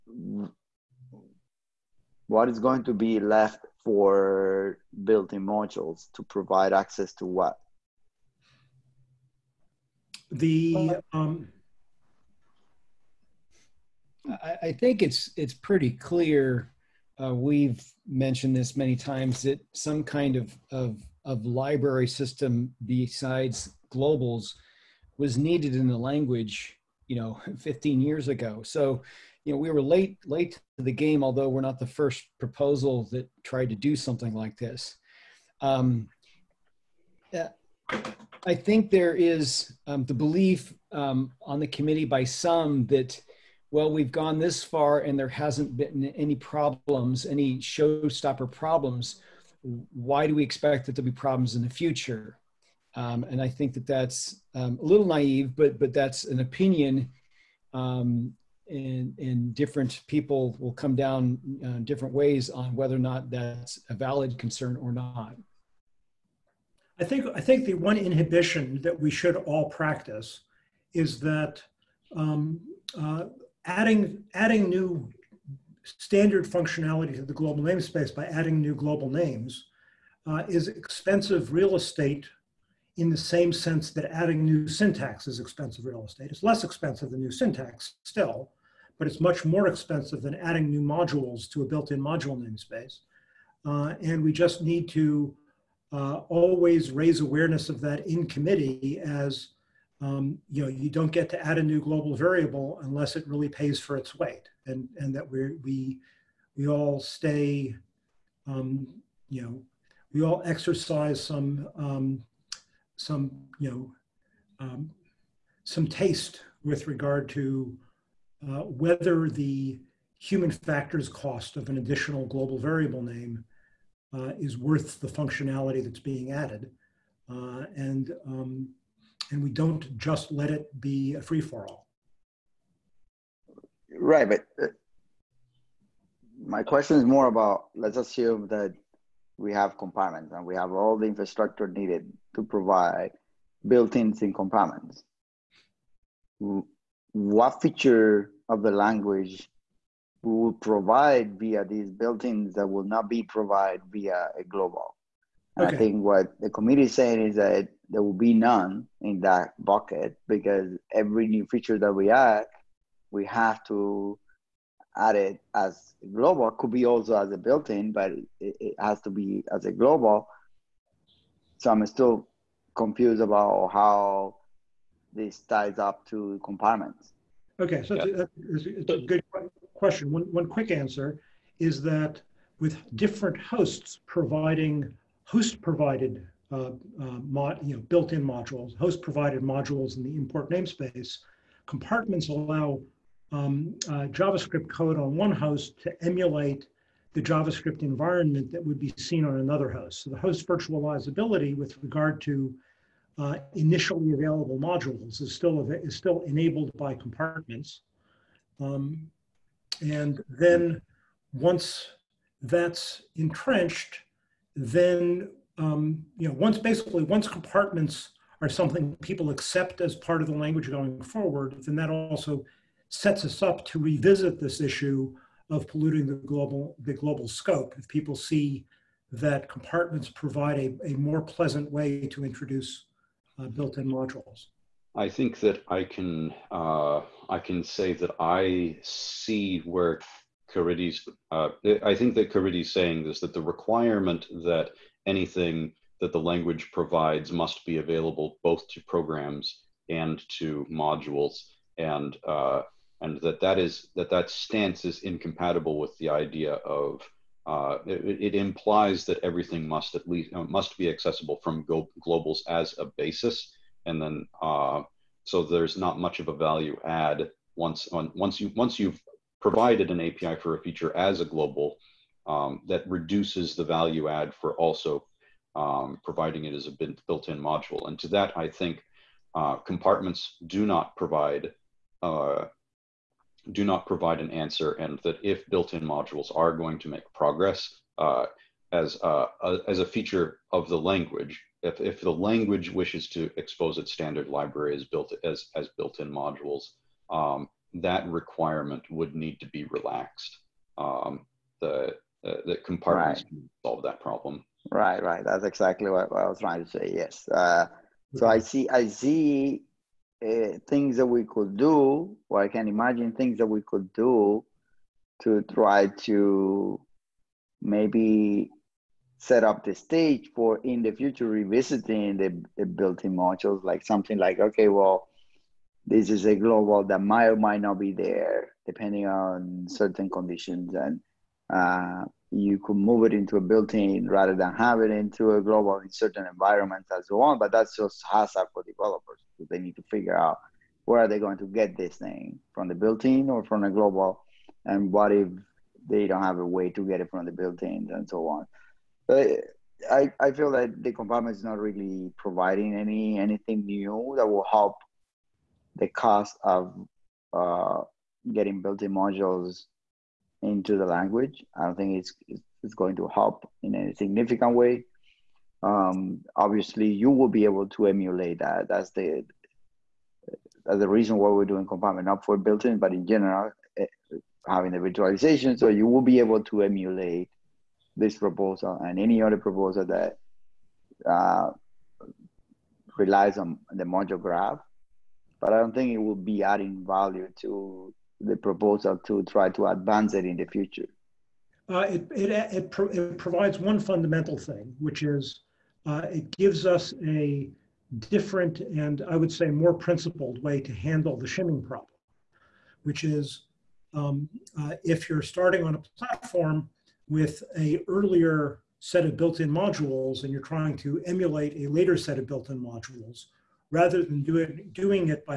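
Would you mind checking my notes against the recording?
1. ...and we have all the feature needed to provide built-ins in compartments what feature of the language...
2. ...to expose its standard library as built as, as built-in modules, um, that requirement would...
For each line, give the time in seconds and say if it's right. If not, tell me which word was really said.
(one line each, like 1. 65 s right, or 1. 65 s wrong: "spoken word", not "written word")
1. 140 s wrong: "infrastructure", not "feature"
2. 293 s right.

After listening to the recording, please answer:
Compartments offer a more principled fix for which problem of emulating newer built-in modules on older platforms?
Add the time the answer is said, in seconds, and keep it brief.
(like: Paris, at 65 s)
The shimming problem, at 401 s.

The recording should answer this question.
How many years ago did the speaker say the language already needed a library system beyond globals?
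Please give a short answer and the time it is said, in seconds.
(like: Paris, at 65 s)
15, at 27 s.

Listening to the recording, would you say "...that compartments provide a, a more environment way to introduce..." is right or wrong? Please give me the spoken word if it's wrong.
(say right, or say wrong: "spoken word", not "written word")
wrong: "pleasant", not "environment".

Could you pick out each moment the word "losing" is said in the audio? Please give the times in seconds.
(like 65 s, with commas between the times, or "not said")
not said.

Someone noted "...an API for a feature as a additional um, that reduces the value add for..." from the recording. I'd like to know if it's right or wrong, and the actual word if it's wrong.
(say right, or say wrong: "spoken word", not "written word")
wrong: "global", not "additional".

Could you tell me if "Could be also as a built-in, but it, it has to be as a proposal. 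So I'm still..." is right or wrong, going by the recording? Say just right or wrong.
wrong.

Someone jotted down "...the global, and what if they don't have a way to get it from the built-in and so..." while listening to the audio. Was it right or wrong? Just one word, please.
right.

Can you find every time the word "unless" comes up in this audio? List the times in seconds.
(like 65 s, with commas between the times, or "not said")
102 s.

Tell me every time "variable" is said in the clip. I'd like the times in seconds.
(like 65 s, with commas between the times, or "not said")
102 s, 122 s.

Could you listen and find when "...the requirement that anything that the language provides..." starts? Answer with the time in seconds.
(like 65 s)
243 s.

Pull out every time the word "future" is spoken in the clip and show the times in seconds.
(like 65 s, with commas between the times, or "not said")
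51 s, 320 s, 390 s.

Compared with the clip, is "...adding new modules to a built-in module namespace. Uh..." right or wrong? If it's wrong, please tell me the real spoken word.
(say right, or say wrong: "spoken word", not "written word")
right.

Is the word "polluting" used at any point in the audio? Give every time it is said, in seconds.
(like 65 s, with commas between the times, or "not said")
225 s.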